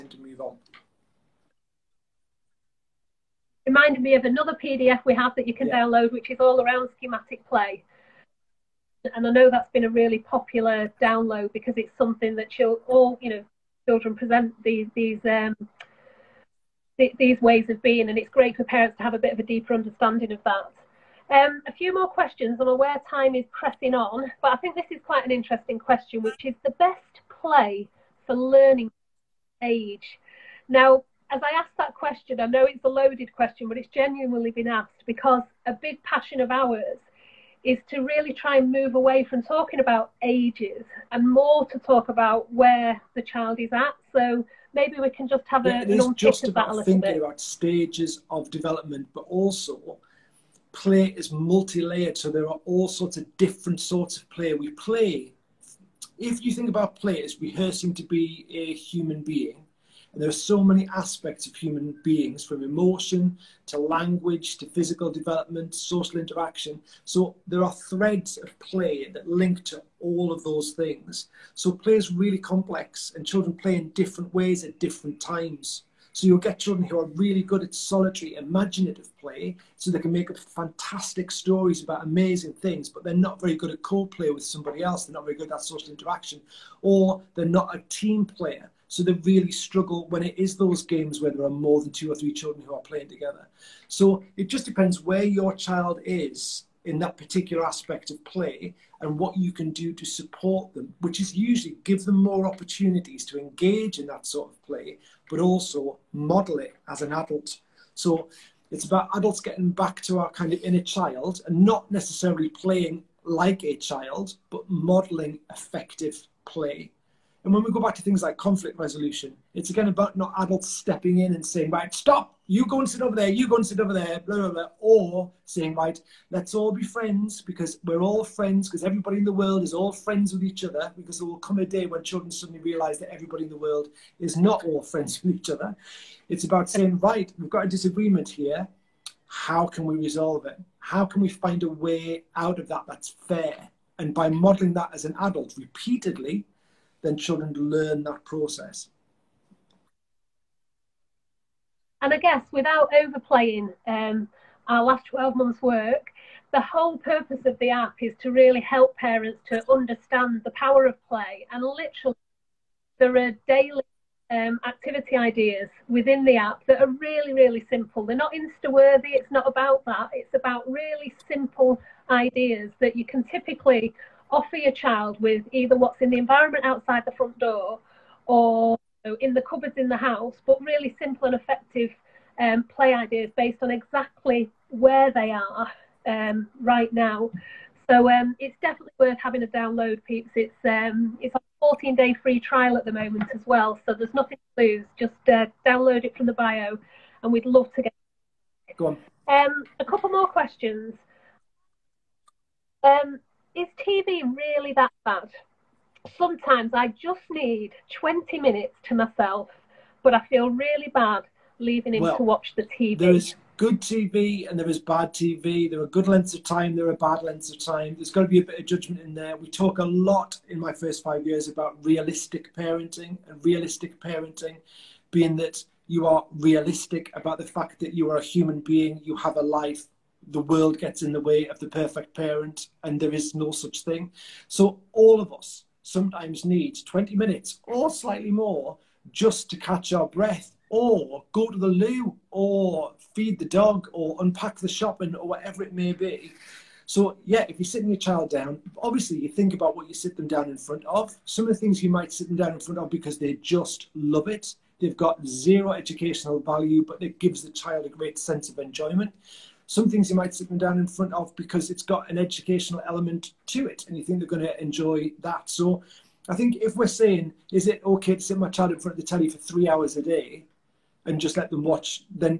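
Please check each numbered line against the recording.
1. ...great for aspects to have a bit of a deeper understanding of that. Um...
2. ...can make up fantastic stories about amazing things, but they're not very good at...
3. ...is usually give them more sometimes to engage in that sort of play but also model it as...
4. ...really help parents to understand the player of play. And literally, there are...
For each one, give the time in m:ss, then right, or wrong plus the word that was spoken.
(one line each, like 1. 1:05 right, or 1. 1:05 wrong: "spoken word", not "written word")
1. 0:18 wrong: "parents", not "aspects"
2. 1:19 right
3. 1:41 wrong: "opportunities", not "sometimes"
4. 2:38 wrong: "power", not "player".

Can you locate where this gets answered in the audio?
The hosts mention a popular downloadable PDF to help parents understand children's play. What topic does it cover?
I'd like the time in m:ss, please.
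0:06.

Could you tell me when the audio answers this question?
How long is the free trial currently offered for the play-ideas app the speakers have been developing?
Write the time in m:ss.
3:11.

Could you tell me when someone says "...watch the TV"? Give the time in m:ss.
3:32.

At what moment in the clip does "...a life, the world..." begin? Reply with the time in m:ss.
3:49.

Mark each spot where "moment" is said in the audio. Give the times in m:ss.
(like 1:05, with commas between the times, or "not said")
3:12.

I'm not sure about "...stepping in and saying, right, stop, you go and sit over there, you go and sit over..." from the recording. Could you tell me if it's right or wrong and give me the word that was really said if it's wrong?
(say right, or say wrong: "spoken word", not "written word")
right.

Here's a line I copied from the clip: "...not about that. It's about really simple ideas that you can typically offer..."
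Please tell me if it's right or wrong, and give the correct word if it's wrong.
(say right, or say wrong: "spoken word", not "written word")
right.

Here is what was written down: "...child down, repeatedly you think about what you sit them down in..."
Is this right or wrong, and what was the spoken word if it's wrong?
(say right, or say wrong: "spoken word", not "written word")
wrong: "obviously", not "repeatedly".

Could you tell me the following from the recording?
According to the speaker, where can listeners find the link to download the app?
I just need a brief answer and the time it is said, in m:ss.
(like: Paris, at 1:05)
The bio, at 3:16.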